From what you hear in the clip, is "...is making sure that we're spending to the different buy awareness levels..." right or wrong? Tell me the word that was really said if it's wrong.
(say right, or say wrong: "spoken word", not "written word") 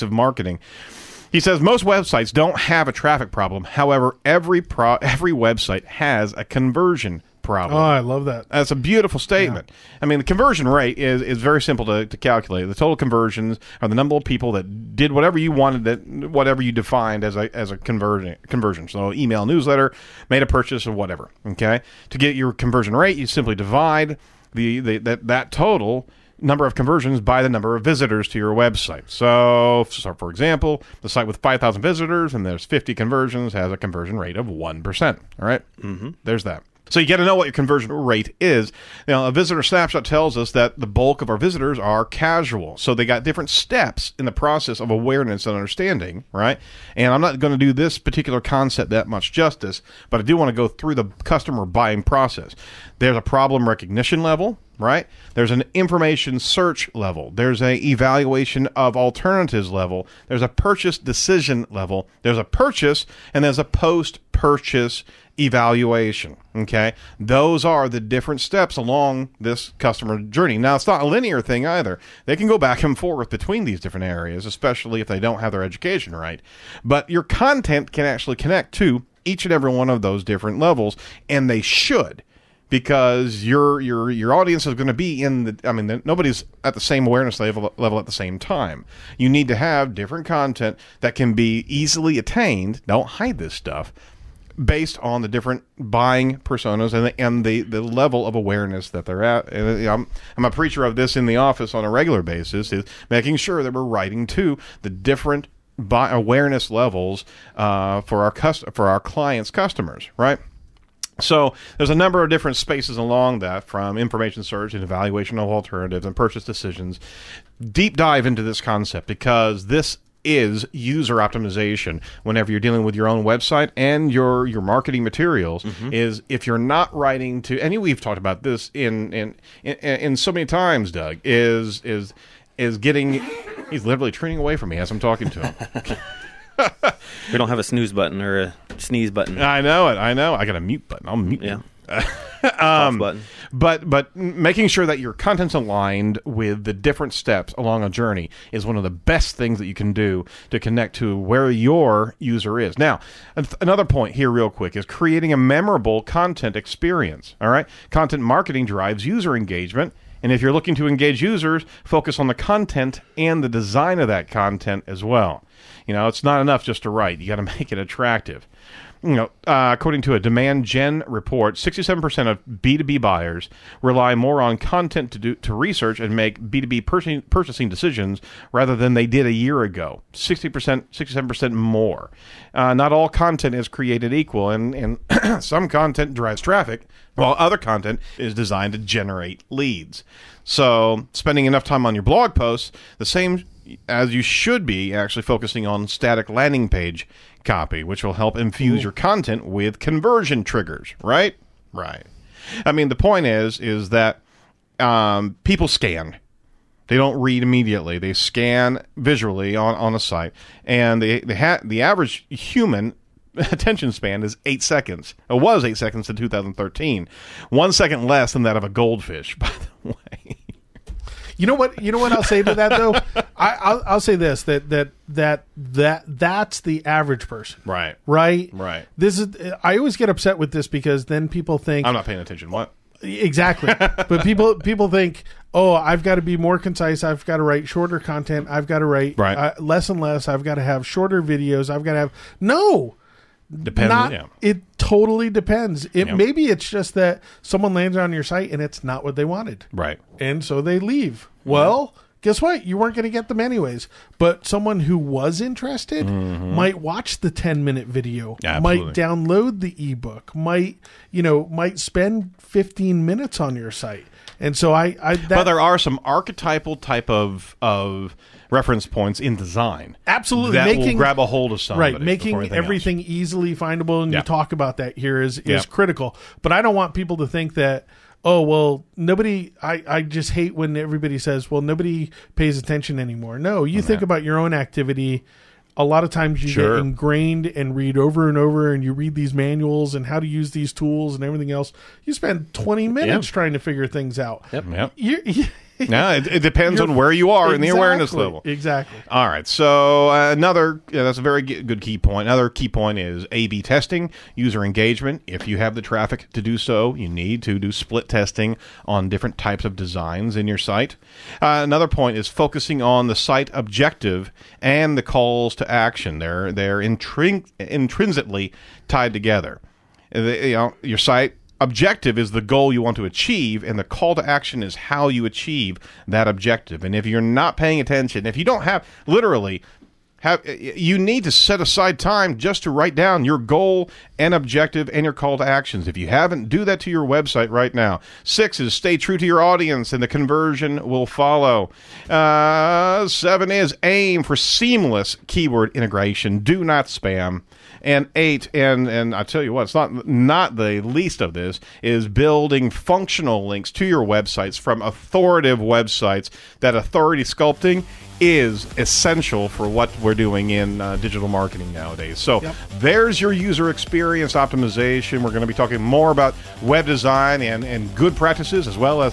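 wrong: "writing", not "spending".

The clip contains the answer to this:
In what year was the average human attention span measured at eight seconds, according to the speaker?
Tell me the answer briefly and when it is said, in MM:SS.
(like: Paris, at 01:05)
2013, at 03:36.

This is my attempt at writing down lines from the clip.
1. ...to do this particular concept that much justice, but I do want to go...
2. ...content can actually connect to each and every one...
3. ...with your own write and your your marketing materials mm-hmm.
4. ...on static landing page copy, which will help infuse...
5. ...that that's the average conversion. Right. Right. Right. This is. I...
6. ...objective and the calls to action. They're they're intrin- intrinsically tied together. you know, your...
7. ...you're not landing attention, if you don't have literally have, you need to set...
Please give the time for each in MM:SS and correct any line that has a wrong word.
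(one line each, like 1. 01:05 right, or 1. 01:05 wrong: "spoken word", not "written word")
1. 00:47 right
2. 01:17 right
3. 02:02 wrong: "website", not "write"
4. 03:15 right
5. 03:45 wrong: "person", not "conversion"
6. 05:13 right
7. 05:27 wrong: "paying", not "landing".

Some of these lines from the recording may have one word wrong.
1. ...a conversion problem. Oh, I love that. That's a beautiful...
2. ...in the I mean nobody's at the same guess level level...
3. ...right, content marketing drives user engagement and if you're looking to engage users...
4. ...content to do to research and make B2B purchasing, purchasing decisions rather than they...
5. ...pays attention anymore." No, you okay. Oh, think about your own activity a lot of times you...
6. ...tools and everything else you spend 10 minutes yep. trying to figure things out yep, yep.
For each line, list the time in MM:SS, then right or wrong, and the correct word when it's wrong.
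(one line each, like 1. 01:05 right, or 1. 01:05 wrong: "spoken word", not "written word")
1. 00:06 right
2. 01:25 wrong: "awareness", not "guess"
3. 02:37 right
4. 02:54 right
5. 04:42 right
6. 04:50 wrong: "20", not "10".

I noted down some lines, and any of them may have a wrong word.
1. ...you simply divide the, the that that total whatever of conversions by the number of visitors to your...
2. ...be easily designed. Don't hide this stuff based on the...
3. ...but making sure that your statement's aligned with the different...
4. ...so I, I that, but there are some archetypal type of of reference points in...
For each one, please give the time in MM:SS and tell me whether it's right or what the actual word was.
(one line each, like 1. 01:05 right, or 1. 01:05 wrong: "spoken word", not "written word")
1. 00:23 wrong: "number", not "whatever"
2. 01:31 wrong: "attained", not "designed"
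3. 02:23 wrong: "content", not "statement"
4. 04:24 right.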